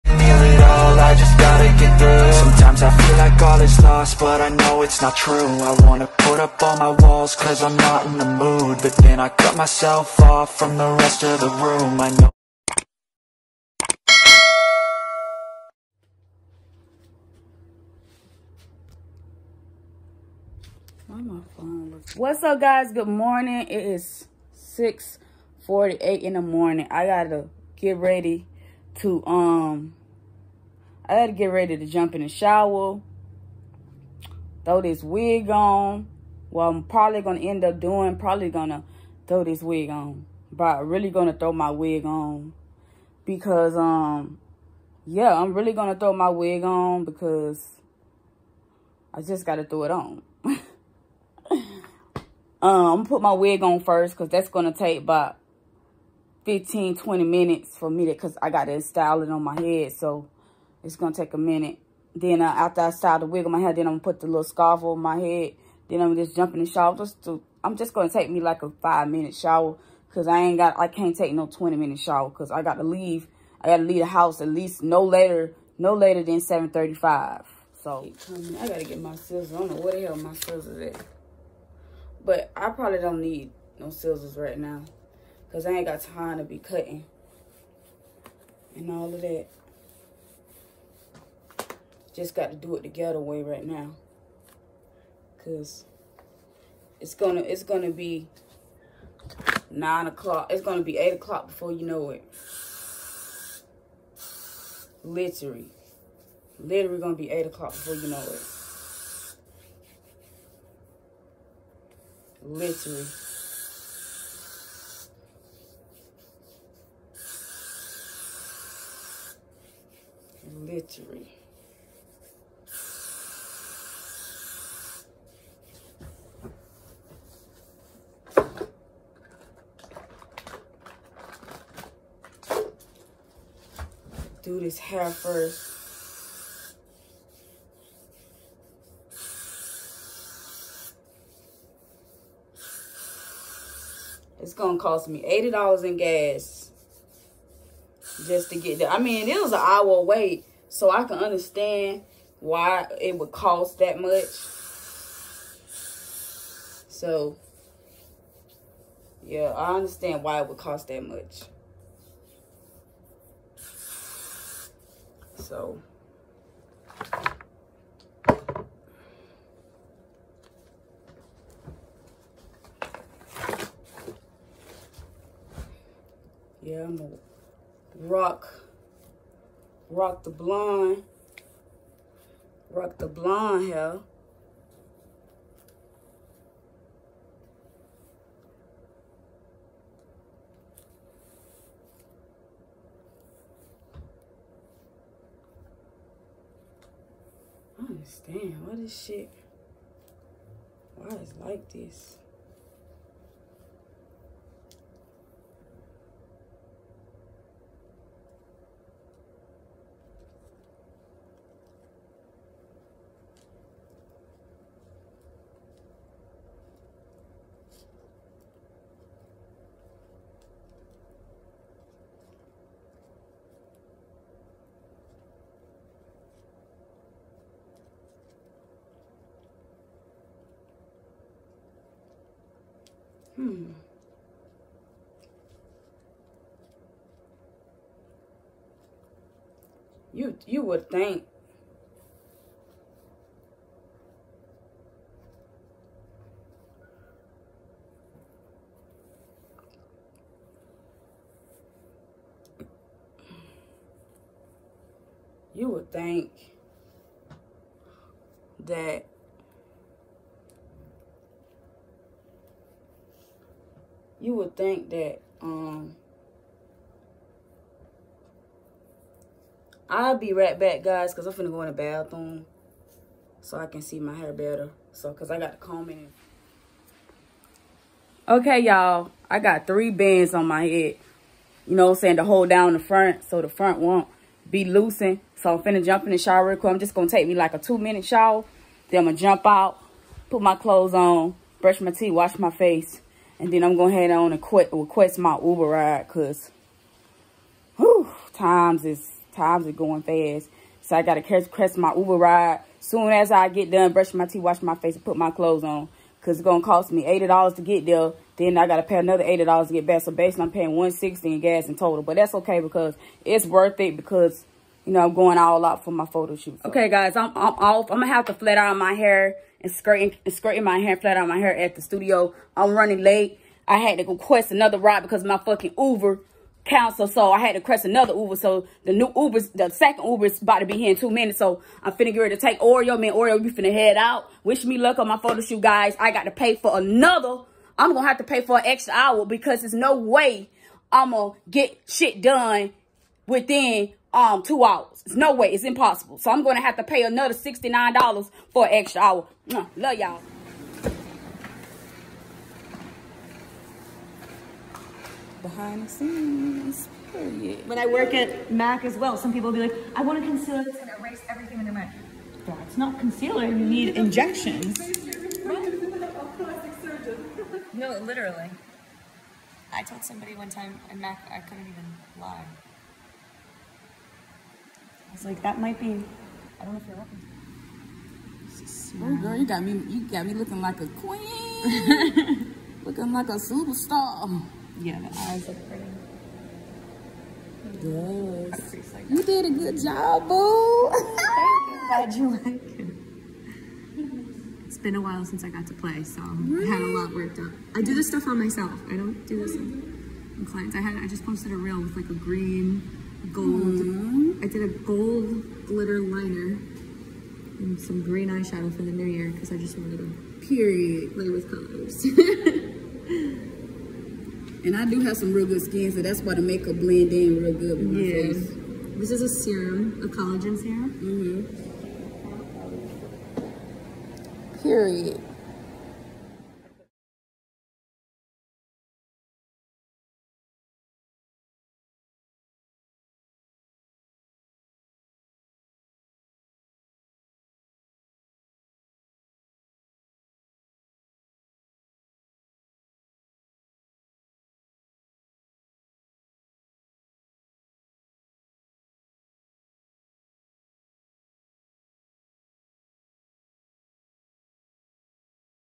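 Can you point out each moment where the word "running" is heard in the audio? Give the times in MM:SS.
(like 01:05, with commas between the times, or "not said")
05:22.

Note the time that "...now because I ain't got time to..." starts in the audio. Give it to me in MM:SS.
01:24.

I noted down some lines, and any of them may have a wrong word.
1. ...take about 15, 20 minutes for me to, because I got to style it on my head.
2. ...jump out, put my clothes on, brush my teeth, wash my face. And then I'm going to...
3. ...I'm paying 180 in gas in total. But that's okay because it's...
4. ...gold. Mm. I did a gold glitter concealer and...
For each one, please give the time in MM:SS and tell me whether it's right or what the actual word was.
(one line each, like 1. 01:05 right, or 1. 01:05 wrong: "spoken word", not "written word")
1. 00:54 right
2. 04:49 right
3. 05:10 wrong: "160", not "180"
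4. 06:43 wrong: "liner", not "concealer".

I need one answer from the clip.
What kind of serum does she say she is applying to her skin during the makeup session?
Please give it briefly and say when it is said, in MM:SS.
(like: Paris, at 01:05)
Collagen serum, at 07:00.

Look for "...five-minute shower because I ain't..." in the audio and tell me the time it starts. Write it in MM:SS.
01:08.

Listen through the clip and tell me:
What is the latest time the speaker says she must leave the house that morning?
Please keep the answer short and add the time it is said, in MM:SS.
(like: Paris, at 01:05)
7:35, at 01:16.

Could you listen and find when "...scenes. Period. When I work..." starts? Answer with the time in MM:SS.
05:55.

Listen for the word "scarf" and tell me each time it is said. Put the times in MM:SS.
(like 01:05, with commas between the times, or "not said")
01:04.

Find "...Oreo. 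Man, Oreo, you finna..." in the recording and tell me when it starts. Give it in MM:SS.
05:32.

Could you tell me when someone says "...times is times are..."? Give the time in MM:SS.
04:58.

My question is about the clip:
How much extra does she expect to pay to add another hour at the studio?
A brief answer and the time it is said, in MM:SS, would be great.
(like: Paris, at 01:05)
$69, at 05:47.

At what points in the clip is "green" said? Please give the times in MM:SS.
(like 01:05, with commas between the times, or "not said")
06:42, 06:48.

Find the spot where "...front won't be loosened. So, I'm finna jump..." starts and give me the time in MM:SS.
04:43.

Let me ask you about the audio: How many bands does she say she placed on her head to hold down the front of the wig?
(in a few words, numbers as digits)
3.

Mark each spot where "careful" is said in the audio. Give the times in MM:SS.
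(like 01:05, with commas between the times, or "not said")
not said.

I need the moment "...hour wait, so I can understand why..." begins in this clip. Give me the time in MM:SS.
02:29.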